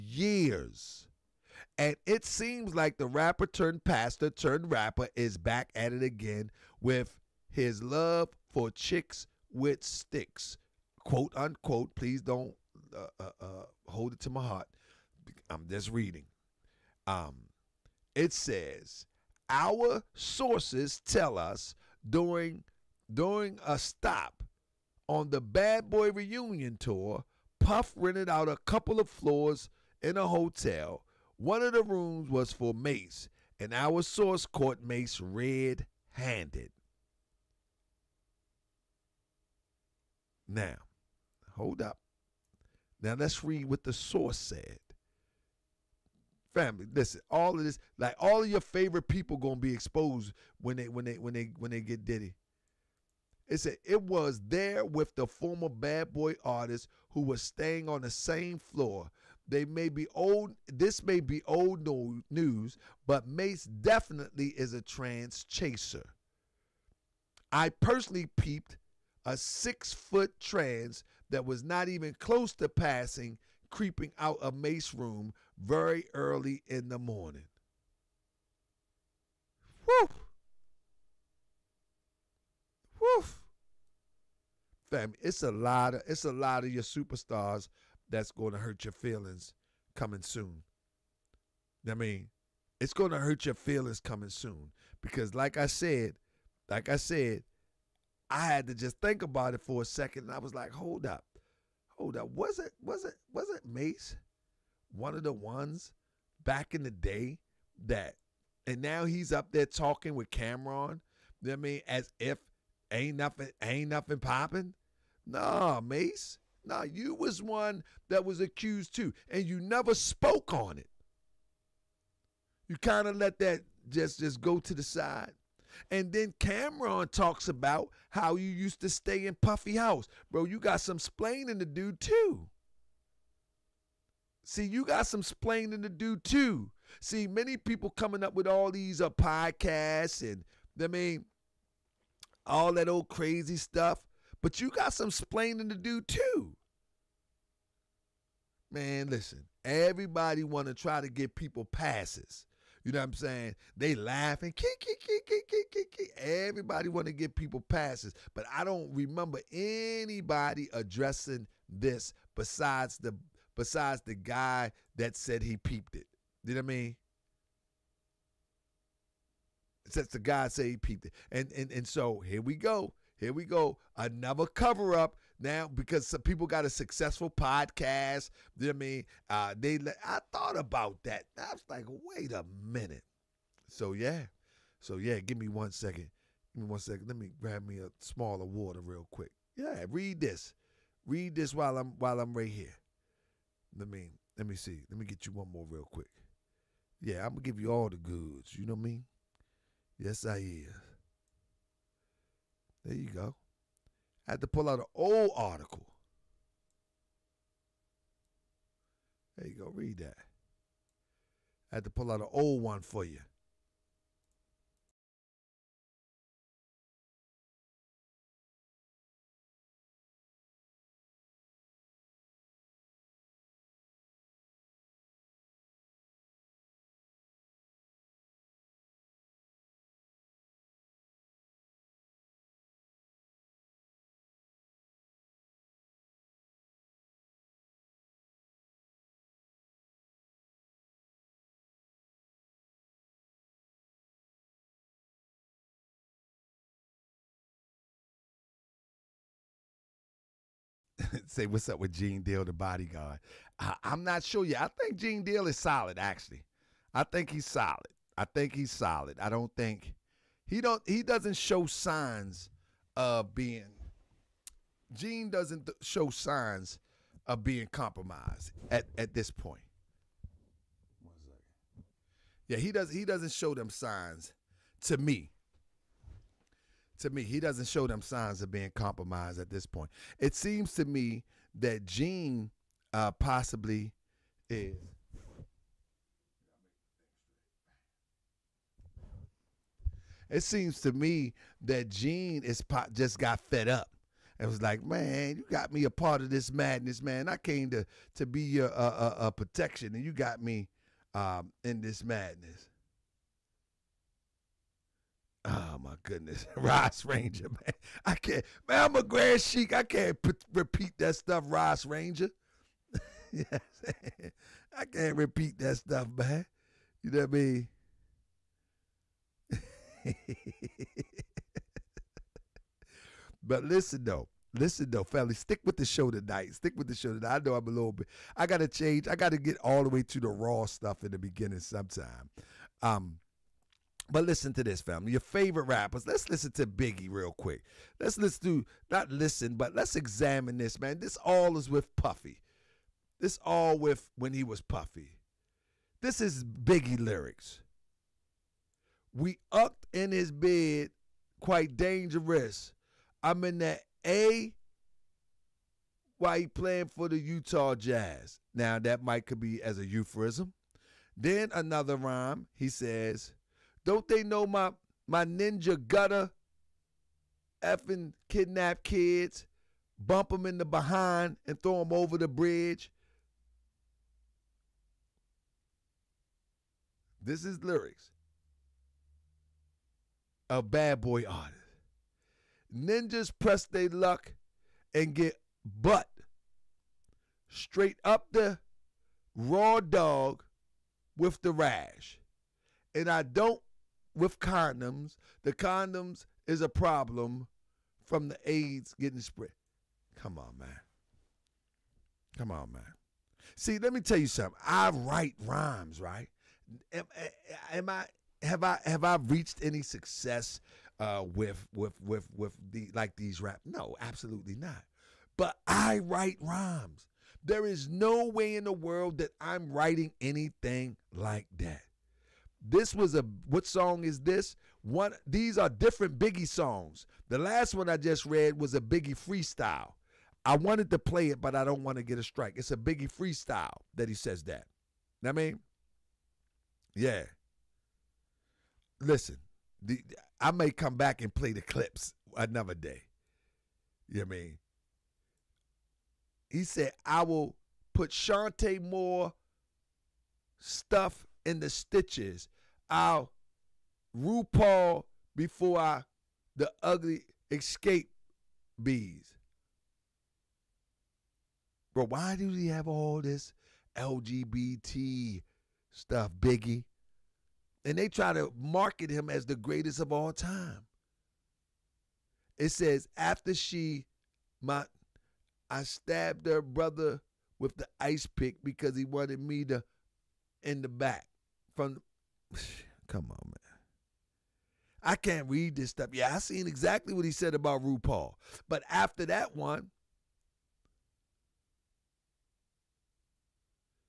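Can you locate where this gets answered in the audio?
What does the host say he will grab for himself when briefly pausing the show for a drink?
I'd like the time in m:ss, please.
3:07.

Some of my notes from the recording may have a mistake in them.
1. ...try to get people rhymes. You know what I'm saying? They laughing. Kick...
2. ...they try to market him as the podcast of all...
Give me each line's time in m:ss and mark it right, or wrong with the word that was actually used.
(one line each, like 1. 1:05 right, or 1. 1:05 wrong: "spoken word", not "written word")
1. 2:30 wrong: "passes", not "rhymes"
2. 7:47 wrong: "greatest", not "podcast".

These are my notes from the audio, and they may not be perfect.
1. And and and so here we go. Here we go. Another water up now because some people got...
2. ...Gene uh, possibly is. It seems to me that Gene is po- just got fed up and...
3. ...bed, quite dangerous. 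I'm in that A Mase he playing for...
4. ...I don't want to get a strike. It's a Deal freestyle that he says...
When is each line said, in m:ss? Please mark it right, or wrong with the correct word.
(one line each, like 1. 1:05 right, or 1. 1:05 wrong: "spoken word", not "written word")
1. 2:51 wrong: "cover", not "water"
2. 4:41 right
3. 5:50 wrong: "Why", not "Mase"
4. 7:11 wrong: "Biggie", not "Deal".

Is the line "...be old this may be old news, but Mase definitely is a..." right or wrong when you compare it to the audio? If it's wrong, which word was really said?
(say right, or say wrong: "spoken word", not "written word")
right.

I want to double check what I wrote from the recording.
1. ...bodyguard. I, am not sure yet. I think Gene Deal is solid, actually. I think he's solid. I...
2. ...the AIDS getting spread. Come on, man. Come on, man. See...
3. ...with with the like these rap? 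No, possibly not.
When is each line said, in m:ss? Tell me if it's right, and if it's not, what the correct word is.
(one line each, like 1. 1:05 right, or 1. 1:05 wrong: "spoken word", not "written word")
1. 4:12 right
2. 6:38 right
3. 6:52 wrong: "absolutely", not "possibly".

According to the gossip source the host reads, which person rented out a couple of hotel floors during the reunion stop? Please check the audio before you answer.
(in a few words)
Puff.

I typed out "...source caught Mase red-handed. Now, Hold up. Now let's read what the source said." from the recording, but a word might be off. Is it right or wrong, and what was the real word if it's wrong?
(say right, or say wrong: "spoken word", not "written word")
right.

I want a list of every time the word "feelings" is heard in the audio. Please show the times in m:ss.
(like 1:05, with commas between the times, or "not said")
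1:28, 1:33.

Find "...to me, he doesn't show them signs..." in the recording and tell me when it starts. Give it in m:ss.
4:36.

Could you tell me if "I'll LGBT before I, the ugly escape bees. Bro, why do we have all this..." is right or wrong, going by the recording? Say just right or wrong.
wrong.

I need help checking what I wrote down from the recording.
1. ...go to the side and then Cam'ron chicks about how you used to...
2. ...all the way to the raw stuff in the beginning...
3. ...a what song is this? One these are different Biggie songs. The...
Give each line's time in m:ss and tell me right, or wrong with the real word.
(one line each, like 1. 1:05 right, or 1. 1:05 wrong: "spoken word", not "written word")
1. 2:04 wrong: "talks", not "chicks"
2. 5:29 right
3. 7:03 right.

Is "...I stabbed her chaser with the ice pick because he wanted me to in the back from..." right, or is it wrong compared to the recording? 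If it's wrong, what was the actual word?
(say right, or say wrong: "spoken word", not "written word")
wrong: "brother", not "chaser".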